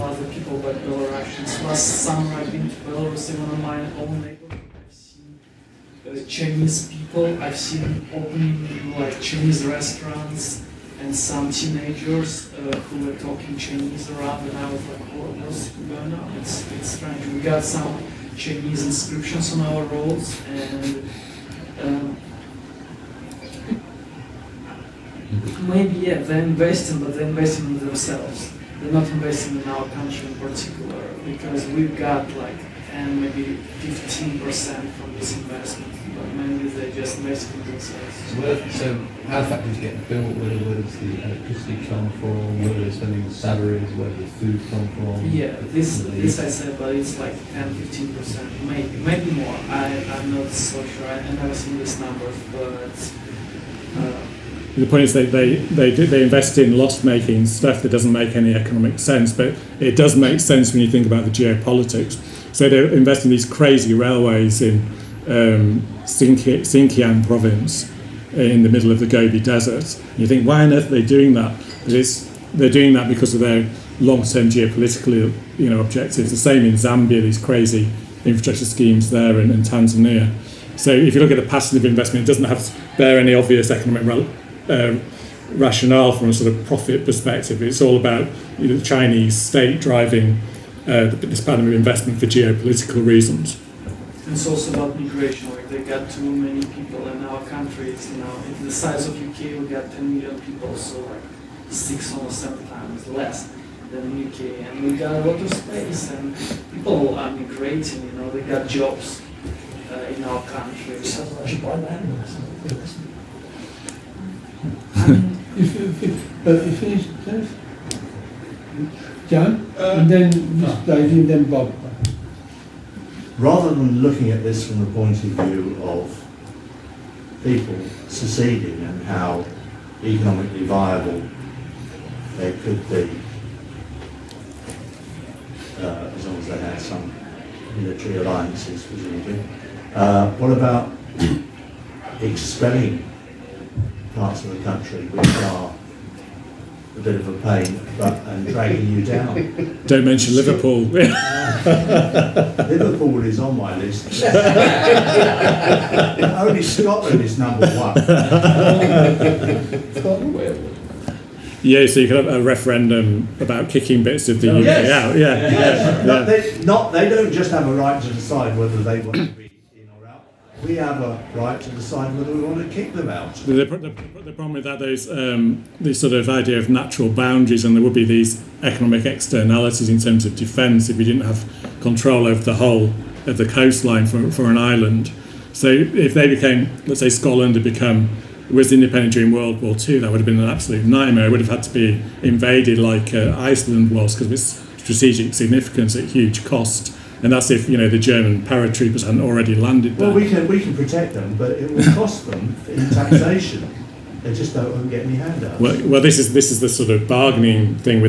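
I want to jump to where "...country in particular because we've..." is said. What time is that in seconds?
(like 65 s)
29 s.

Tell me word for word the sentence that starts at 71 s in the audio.
But it's, they're doing that because of their long-term geopolitical you know, objectives.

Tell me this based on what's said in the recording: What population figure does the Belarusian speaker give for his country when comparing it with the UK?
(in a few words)
10 million.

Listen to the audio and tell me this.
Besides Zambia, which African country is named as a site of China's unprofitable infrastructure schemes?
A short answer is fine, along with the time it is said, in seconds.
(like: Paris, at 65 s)
Tanzania, at 79 s.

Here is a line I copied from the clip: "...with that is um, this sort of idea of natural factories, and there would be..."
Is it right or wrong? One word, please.
wrong.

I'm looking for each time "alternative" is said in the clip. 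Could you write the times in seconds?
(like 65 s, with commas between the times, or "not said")
not said.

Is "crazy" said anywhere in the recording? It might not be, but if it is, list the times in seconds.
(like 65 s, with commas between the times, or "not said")
63 s, 77 s.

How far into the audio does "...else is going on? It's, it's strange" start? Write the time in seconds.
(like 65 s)
15 s.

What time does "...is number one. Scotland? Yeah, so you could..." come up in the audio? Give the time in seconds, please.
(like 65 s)
157 s.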